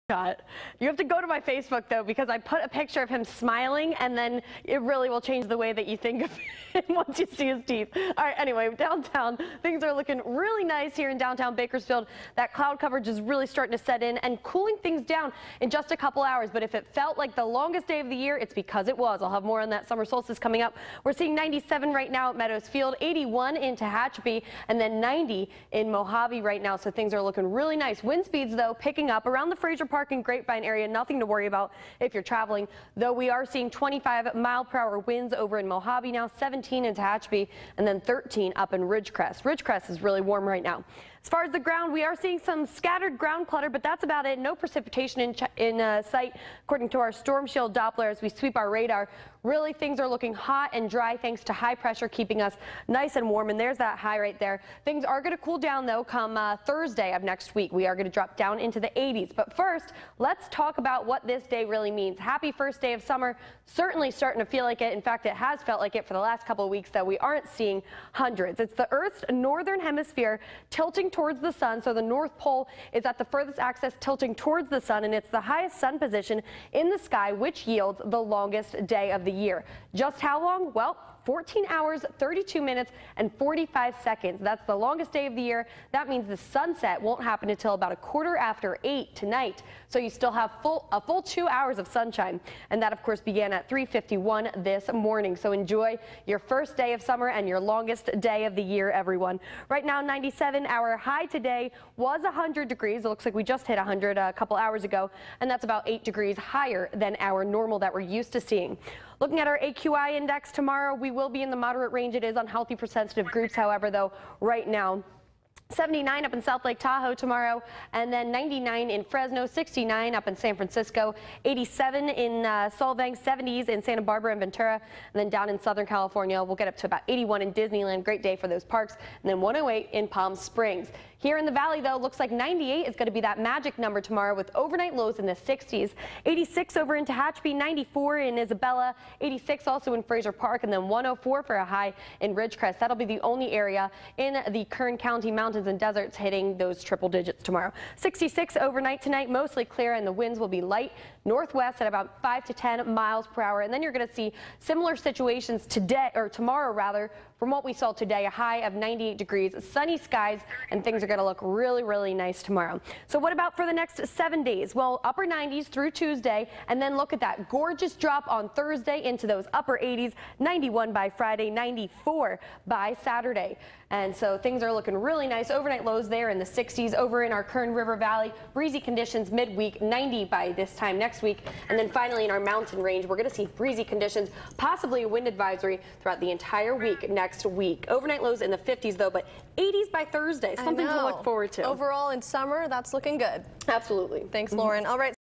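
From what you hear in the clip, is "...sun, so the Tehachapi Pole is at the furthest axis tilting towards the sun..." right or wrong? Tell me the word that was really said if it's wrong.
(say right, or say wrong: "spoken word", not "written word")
wrong: "North", not "Tehachapi".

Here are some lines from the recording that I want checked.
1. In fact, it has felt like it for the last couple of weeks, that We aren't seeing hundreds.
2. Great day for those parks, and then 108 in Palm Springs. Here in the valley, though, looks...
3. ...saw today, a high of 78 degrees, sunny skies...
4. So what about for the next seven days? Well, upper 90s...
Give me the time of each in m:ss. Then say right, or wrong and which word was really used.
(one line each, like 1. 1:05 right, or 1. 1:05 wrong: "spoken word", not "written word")
1. 1:04 right
2. 2:08 right
3. 2:37 wrong: "98", not "78"
4. 2:43 right.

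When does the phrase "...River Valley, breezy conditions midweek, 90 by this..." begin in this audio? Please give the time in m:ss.
2:57.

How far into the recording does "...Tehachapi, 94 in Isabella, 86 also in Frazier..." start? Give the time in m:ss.
2:17.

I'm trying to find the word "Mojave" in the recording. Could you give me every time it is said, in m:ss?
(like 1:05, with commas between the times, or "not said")
0:25, 0:35.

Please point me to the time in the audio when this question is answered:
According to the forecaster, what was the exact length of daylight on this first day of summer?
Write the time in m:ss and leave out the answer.
1:21.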